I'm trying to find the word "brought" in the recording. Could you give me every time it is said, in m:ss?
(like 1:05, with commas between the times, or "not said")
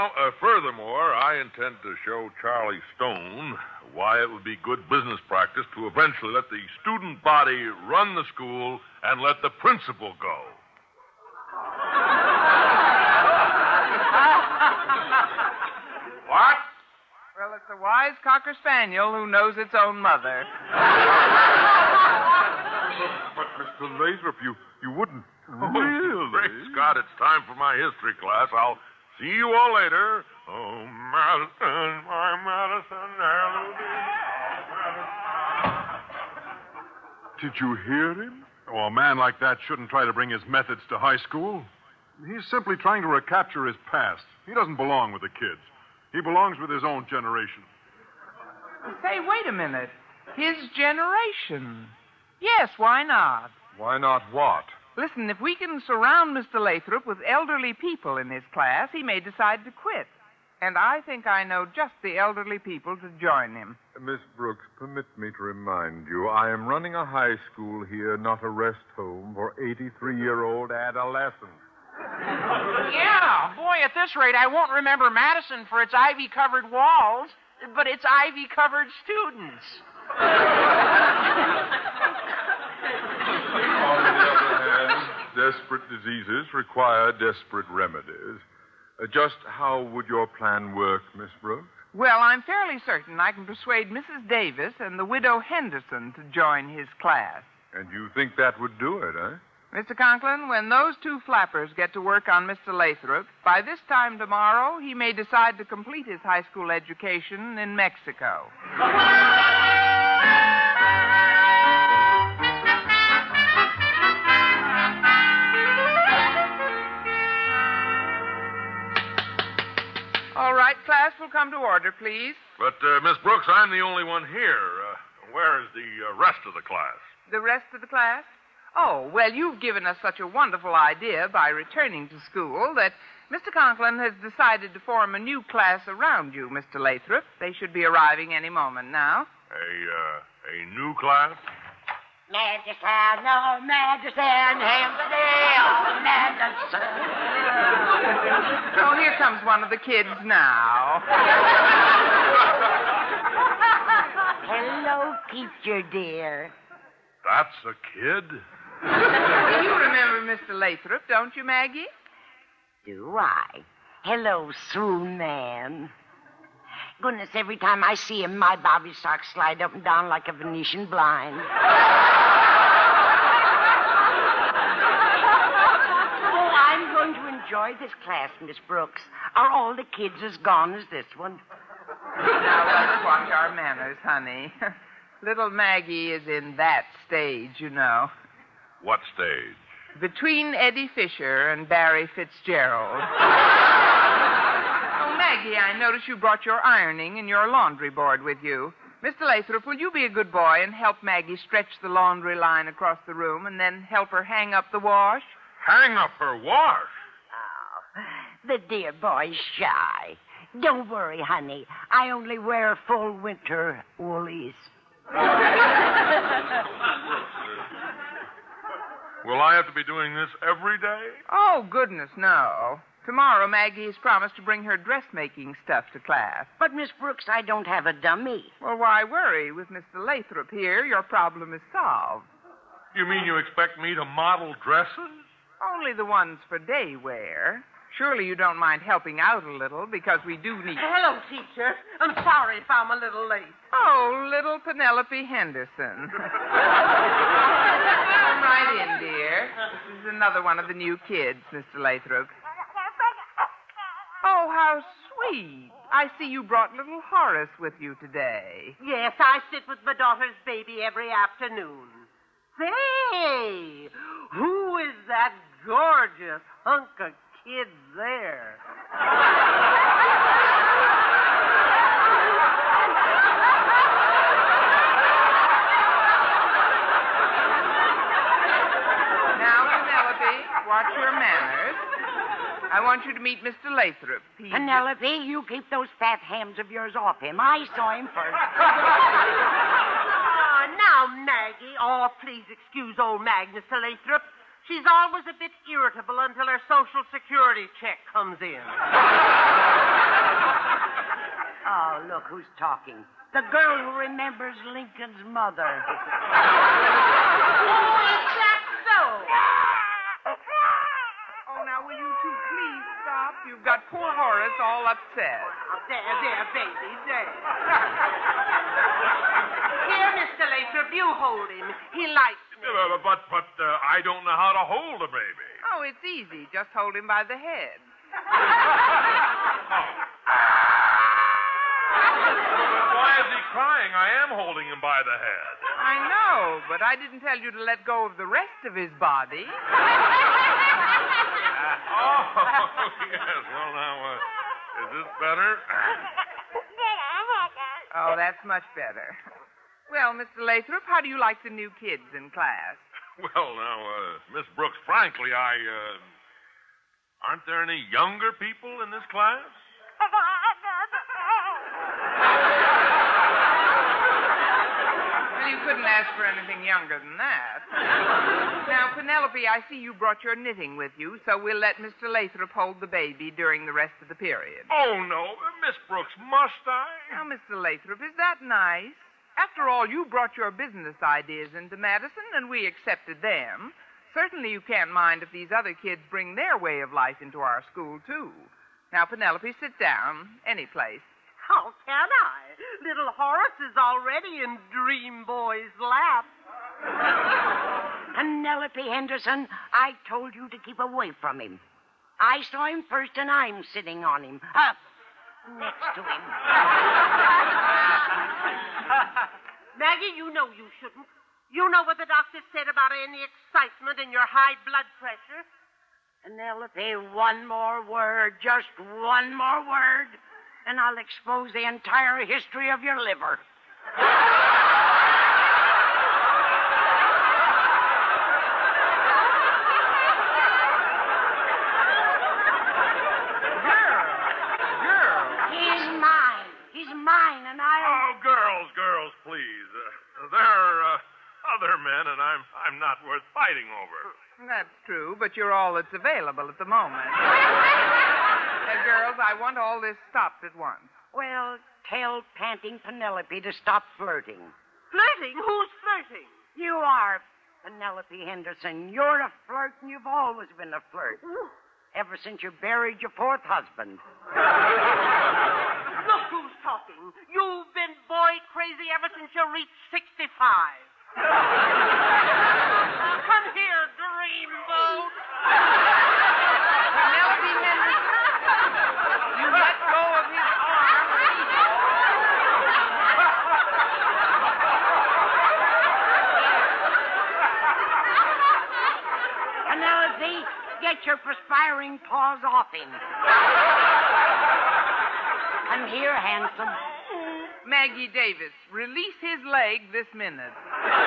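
3:16, 4:16, 6:09, 6:20.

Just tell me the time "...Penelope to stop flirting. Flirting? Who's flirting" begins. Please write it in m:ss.
7:32.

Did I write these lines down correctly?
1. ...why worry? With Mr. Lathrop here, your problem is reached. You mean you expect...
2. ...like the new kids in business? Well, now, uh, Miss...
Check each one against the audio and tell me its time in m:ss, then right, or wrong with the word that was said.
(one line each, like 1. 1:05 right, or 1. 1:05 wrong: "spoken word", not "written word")
1. 3:48 wrong: "solved", not "reached"
2. 5:51 wrong: "class", not "business".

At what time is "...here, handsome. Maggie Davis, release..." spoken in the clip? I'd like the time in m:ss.
8:15.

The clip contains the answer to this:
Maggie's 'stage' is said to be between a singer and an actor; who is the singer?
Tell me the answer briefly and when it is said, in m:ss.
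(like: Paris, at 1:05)
Eddie Fisher, at 3:10.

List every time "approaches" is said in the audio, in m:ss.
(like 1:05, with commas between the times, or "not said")
not said.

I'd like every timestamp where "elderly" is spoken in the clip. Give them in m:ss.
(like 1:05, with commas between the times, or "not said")
0:57, 1:02.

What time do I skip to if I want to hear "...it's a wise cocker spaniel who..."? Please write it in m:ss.
0:17.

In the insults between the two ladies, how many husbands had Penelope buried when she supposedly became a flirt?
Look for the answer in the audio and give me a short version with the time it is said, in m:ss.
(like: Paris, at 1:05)
4, at 7:43.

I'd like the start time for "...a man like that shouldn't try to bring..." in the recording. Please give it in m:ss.
0:38.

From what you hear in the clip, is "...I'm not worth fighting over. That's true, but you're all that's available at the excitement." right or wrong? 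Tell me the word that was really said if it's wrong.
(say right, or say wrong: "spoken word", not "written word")
wrong: "moment", not "excitement".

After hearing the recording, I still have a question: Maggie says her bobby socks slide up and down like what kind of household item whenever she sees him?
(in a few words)
Venetian blind.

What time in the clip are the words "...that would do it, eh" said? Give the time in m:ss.
1:38.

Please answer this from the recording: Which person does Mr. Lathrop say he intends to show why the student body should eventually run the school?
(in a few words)
Charlie Stone.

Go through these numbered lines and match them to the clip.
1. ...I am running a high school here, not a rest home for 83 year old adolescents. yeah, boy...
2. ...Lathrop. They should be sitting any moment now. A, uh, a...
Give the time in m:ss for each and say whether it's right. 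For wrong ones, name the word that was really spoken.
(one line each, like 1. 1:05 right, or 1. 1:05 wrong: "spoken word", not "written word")
1. 1:06 right
2. 2:16 wrong: "arriving", not "sitting".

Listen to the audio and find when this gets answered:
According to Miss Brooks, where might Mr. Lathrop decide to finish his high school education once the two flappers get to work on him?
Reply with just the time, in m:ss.
1:47.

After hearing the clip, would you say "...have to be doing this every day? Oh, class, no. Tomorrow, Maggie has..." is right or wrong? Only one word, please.
wrong.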